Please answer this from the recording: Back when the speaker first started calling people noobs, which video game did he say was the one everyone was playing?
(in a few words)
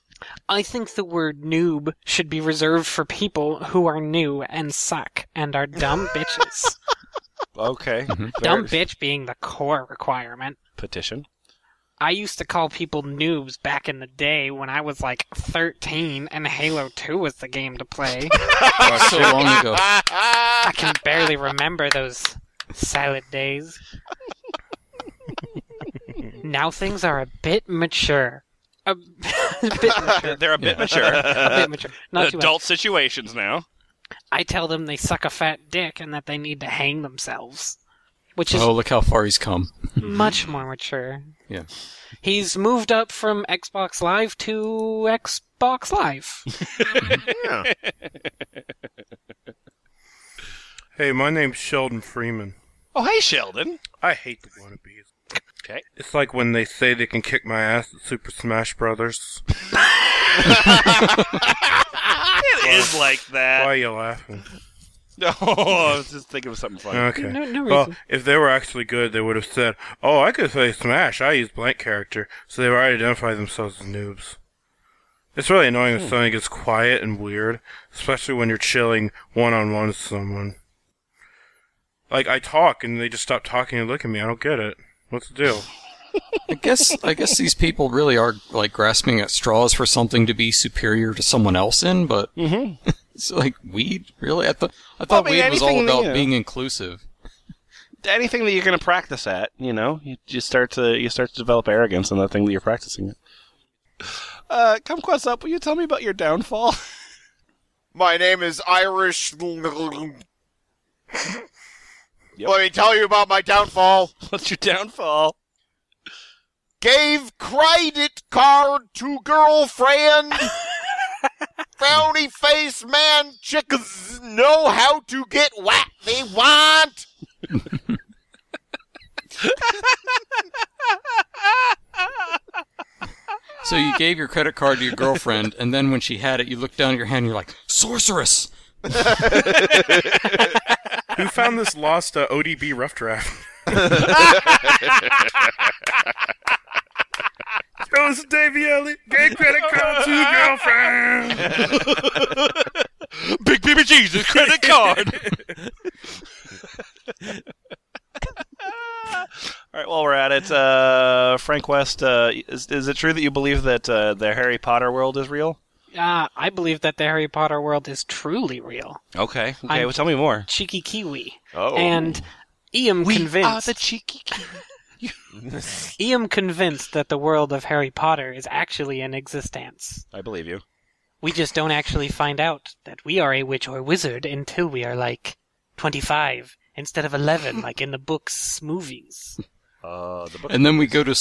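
Halo 2.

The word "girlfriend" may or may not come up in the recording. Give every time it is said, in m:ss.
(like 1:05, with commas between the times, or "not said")
1:59, 2:14, 2:31.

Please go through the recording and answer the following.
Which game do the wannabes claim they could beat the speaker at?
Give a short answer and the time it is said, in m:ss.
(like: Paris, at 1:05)
Super Smash Brothers, at 0:58.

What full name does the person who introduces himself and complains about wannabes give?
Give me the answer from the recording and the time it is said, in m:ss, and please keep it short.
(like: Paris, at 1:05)
Sheldon Freeman, at 0:51.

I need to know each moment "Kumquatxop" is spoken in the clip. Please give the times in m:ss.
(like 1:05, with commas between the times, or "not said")
1:44.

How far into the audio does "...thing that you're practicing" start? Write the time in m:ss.
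1:42.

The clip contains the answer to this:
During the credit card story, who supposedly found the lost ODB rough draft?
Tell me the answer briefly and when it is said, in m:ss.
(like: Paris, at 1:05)
Davey Elliott, at 2:28.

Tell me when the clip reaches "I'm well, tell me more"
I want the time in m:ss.
2:49.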